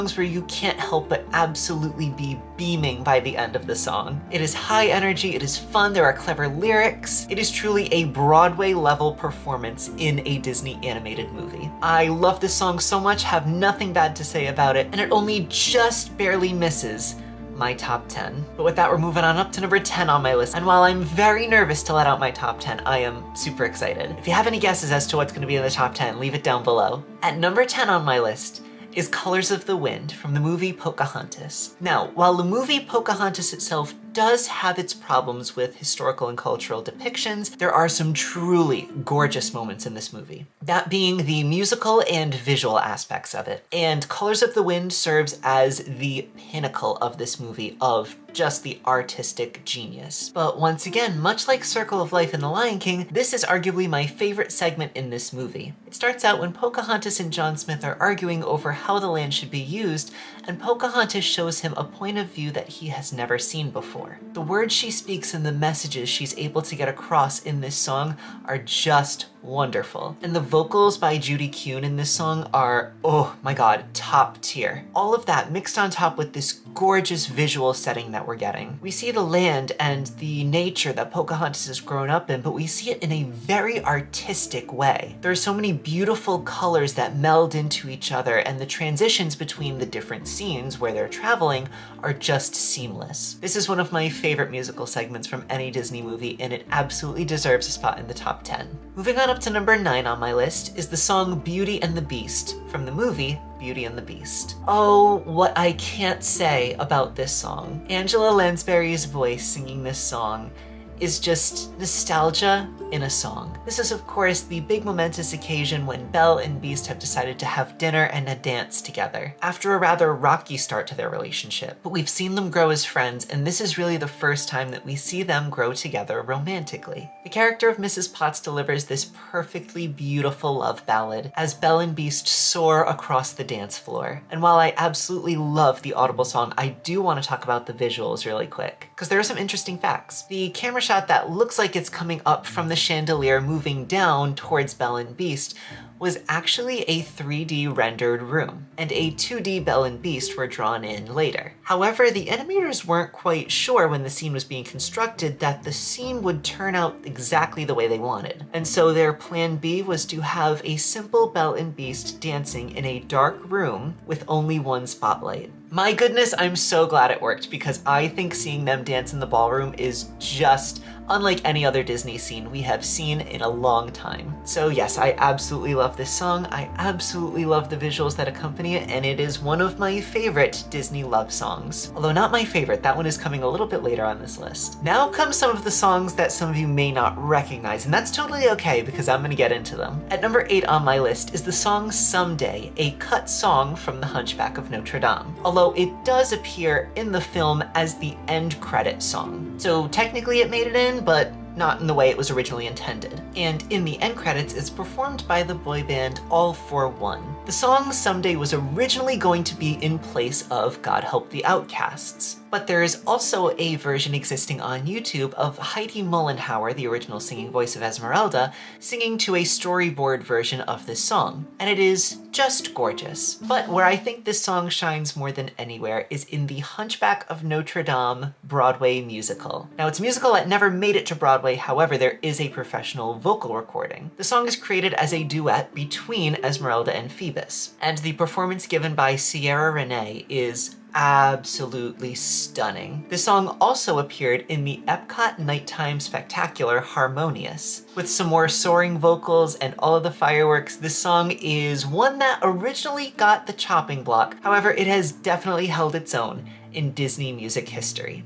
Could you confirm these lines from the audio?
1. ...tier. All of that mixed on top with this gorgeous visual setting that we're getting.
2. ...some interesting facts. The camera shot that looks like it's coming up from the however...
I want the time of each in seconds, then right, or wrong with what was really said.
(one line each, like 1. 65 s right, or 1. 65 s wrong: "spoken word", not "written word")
1. 74 s right
2. 139 s wrong: "chandelier", not "however".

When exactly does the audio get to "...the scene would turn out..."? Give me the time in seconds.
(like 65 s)
155 s.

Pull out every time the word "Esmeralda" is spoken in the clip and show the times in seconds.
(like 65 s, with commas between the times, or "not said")
217 s, 236 s.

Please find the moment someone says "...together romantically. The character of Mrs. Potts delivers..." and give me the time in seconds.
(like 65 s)
125 s.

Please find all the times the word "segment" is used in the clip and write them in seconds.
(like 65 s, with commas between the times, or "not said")
54 s, 94 s.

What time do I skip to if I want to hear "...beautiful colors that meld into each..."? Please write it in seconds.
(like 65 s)
85 s.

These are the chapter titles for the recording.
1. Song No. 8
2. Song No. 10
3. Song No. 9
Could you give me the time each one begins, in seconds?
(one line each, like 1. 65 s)
1. 189 s
2. 26 s
3. 98 s.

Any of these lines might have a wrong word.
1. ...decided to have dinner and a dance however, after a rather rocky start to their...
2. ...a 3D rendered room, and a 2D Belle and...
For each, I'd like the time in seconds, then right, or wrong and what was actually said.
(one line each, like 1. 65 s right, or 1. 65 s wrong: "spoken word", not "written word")
1. 116 s wrong: "together", not "however"
2. 146 s right.